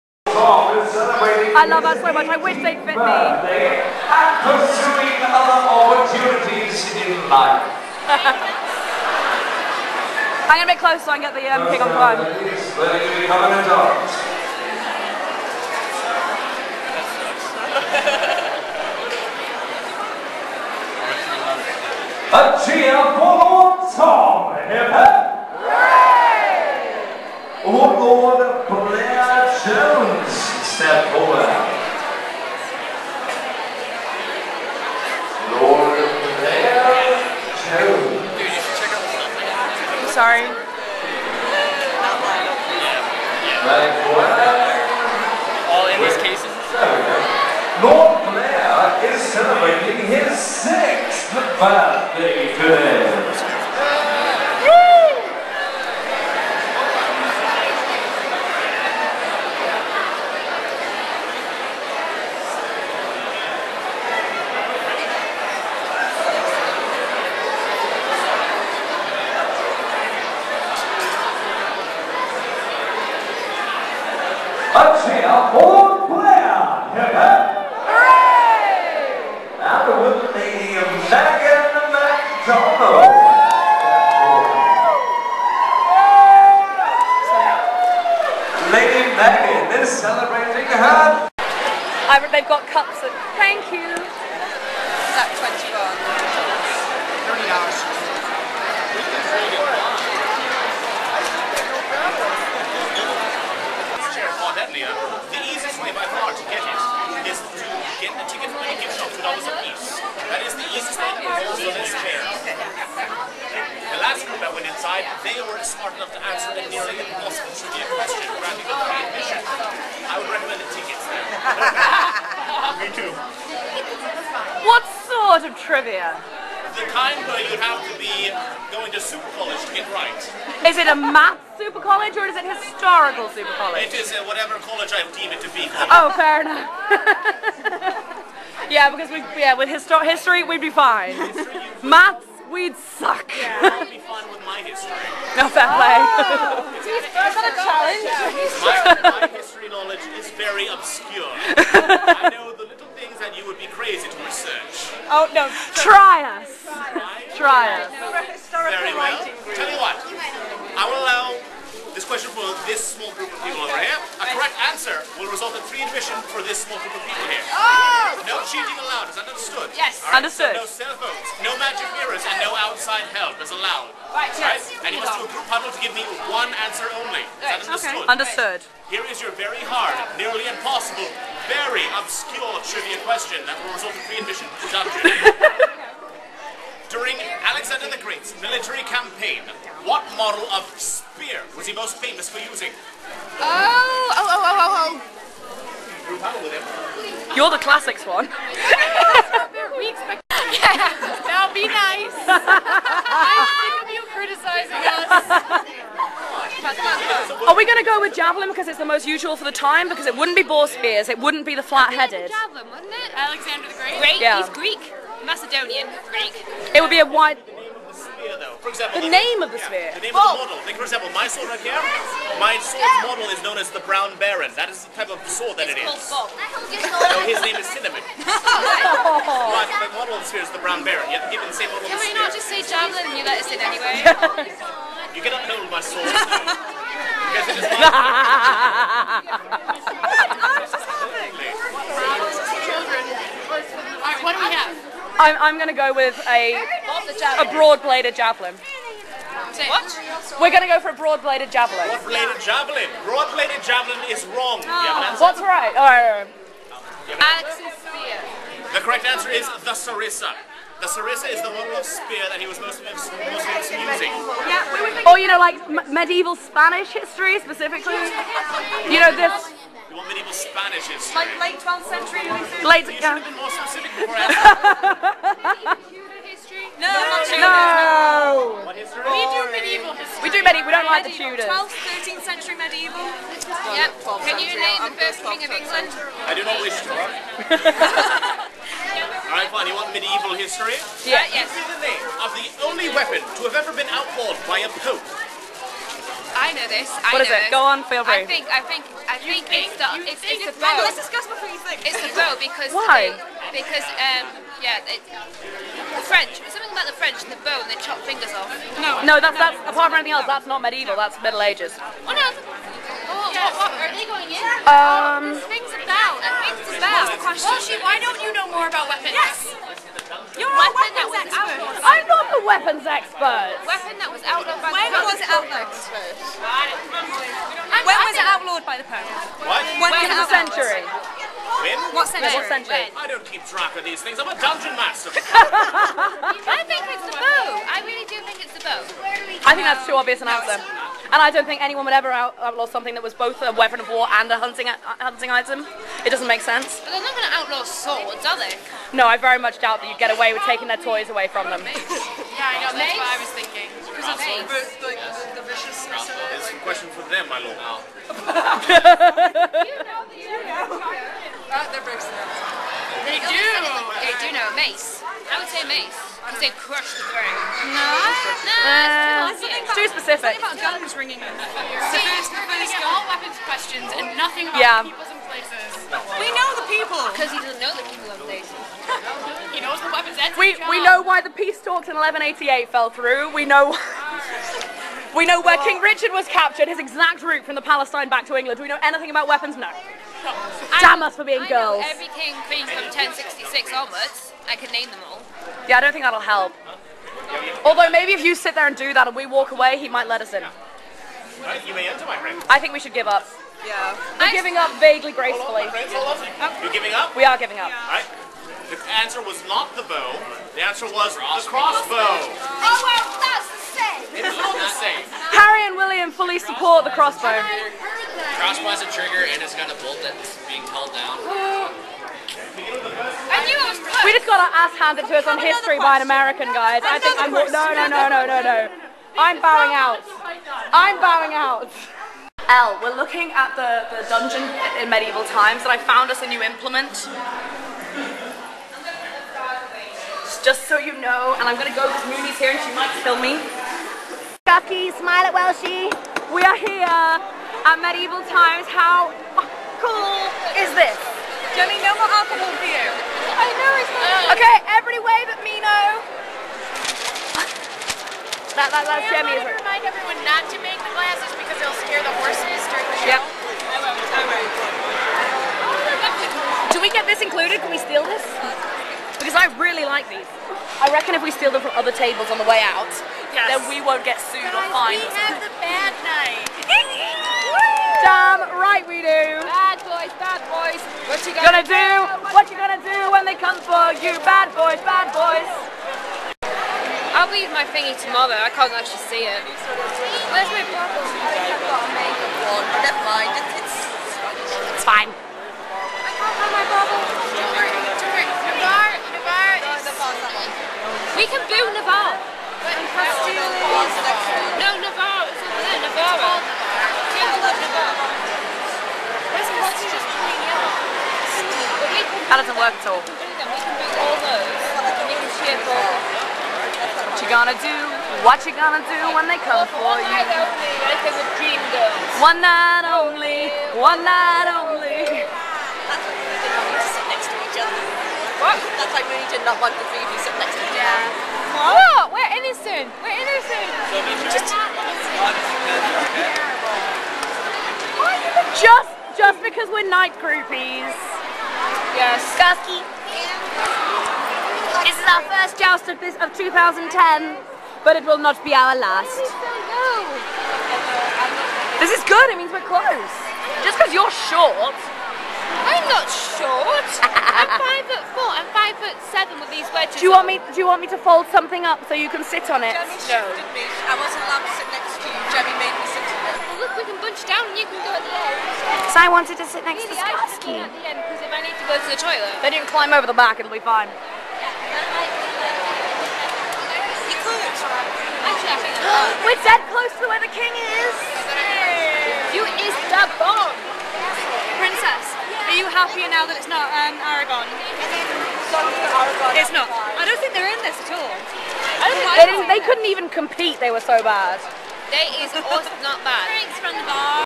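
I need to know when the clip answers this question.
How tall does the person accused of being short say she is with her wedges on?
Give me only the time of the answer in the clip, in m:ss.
9:18.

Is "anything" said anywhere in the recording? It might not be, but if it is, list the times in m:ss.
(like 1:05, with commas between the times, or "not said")
5:10, 6:28.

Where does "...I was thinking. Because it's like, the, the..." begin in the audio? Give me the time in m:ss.
5:53.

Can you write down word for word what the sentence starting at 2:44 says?
A correct answer will result in free admission for this small group of people here.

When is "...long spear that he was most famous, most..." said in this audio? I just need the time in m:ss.
4:21.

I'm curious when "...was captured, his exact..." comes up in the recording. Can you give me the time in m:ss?
6:26.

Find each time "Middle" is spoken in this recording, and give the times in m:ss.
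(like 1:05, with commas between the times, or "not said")
5:11.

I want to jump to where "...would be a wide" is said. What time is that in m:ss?
3:36.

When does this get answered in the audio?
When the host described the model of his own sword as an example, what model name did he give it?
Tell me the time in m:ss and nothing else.
3:43.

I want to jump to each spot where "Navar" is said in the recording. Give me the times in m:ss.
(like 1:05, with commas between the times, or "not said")
8:21.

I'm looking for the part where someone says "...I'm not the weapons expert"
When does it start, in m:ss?
5:21.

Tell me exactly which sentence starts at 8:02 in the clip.
What, what you gonna do when they come for you?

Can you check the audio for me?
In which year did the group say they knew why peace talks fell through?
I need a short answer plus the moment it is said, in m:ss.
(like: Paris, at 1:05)
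1188, at 6:21.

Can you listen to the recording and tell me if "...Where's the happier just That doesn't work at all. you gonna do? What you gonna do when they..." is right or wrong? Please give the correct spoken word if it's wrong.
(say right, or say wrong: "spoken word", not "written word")
wrong: "water", not "happier".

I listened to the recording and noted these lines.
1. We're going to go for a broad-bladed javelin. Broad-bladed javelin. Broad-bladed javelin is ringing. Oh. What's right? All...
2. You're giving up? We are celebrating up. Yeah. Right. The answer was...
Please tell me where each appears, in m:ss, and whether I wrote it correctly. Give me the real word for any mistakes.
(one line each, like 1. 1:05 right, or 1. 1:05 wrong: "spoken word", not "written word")
1. 4:10 wrong: "wrong", not "ringing"
2. 6:45 wrong: "giving", not "celebrating".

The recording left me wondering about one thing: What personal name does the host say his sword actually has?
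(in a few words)
Cinnamon.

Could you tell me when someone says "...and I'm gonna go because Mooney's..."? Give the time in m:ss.
7:21.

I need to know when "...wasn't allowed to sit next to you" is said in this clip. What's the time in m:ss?
9:23.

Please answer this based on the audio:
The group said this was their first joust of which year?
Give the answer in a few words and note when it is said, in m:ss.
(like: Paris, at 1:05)
2010, at 9:05.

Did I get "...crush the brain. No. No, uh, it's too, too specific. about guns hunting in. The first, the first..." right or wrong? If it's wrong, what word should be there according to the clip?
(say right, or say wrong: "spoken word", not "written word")
wrong: "ringing", not "hunting".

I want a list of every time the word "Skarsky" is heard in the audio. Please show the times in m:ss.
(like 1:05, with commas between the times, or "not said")
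9:30.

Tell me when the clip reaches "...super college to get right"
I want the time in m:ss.
2:08.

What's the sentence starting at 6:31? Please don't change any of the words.
every king queen from 1066 onwards.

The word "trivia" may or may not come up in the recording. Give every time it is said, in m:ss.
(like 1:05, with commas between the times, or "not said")
1:57, 2:05, 3:02.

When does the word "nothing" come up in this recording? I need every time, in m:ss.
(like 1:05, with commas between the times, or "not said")
6:14.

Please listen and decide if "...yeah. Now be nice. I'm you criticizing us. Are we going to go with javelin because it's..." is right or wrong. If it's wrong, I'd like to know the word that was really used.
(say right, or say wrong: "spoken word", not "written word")
right.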